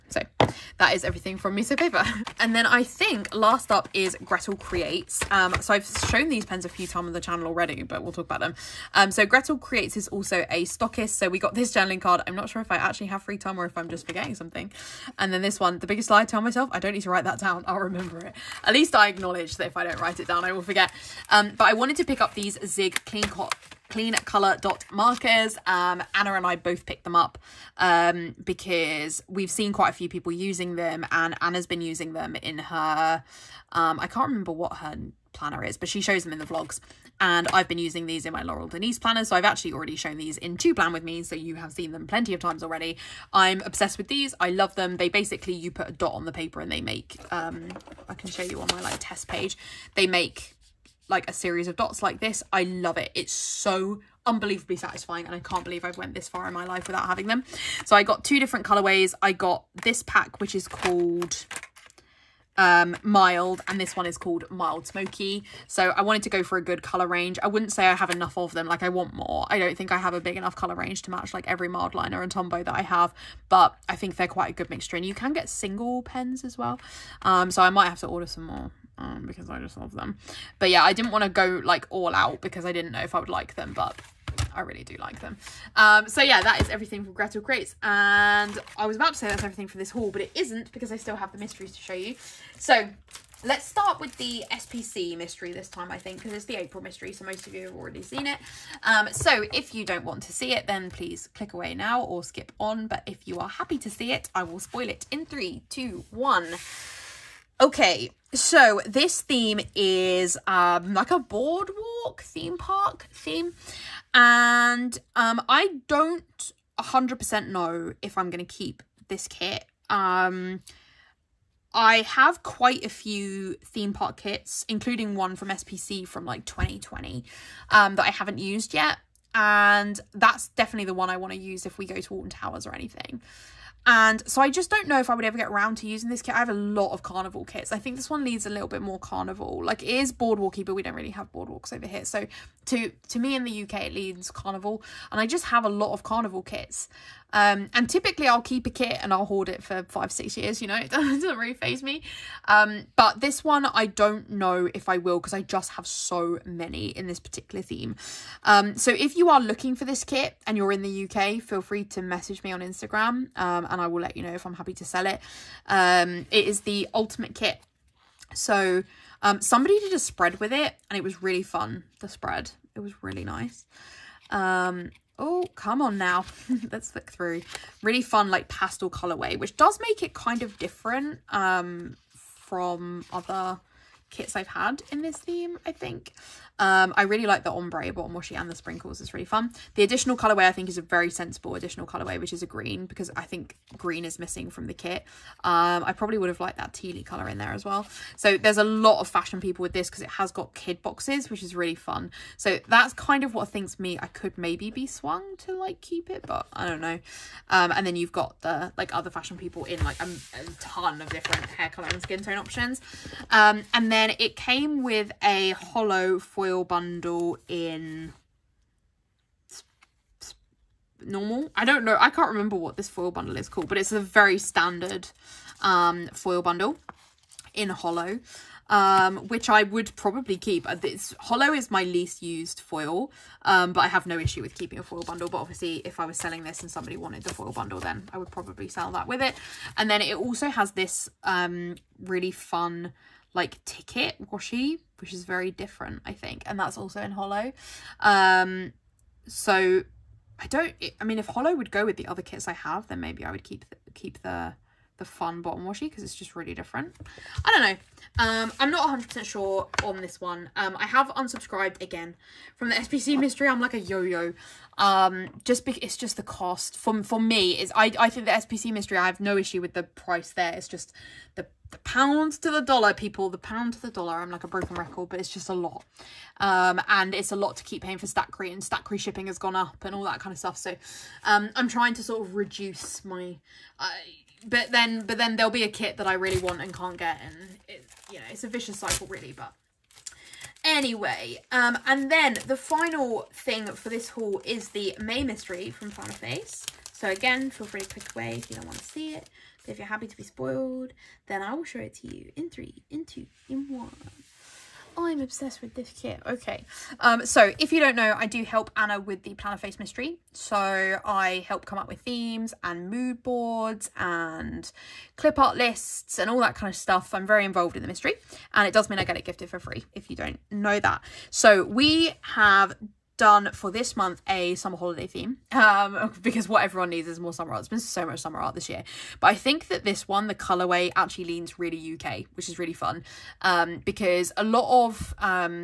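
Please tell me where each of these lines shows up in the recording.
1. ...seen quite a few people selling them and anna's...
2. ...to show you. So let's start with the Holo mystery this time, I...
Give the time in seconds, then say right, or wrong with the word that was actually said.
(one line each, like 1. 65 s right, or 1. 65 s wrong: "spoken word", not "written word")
1. 29 s wrong: "using", not "selling"
2. 91 s wrong: "SPC", not "Holo".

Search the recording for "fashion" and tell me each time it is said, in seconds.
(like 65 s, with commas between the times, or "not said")
199 s, 209 s.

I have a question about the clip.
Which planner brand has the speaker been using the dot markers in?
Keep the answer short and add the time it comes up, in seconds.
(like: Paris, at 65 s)
Laurel Denise, at 38 s.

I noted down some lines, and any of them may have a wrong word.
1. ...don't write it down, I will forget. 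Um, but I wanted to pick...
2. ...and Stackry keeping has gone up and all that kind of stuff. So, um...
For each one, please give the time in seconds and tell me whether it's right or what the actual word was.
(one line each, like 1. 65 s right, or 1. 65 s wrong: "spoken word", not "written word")
1. 19 s right
2. 278 s wrong: "shipping", not "keeping".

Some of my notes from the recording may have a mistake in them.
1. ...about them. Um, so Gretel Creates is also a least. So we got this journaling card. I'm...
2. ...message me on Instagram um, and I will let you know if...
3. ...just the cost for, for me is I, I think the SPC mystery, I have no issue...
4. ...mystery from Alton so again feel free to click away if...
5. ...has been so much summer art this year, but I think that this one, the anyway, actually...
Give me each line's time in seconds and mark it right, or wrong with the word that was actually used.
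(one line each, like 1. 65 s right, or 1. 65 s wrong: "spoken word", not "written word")
1. 8 s wrong: "stockist", not "least"
2. 162 s right
3. 265 s right
4. 295 s wrong: "Plannerface", not "Alton"
5. 327 s wrong: "colorway", not "anyway".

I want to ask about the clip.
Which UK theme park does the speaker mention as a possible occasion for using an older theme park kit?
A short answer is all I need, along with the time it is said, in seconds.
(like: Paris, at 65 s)
Alton Towers, at 132 s.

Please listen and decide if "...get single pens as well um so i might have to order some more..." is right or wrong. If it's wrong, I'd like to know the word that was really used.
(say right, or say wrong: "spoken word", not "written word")
right.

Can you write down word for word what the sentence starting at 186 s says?
Um, I really like the ombre bottom washi and the sprinkles.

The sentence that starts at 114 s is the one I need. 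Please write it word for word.
And um, I don't 100% know if I'm going to keep this kit.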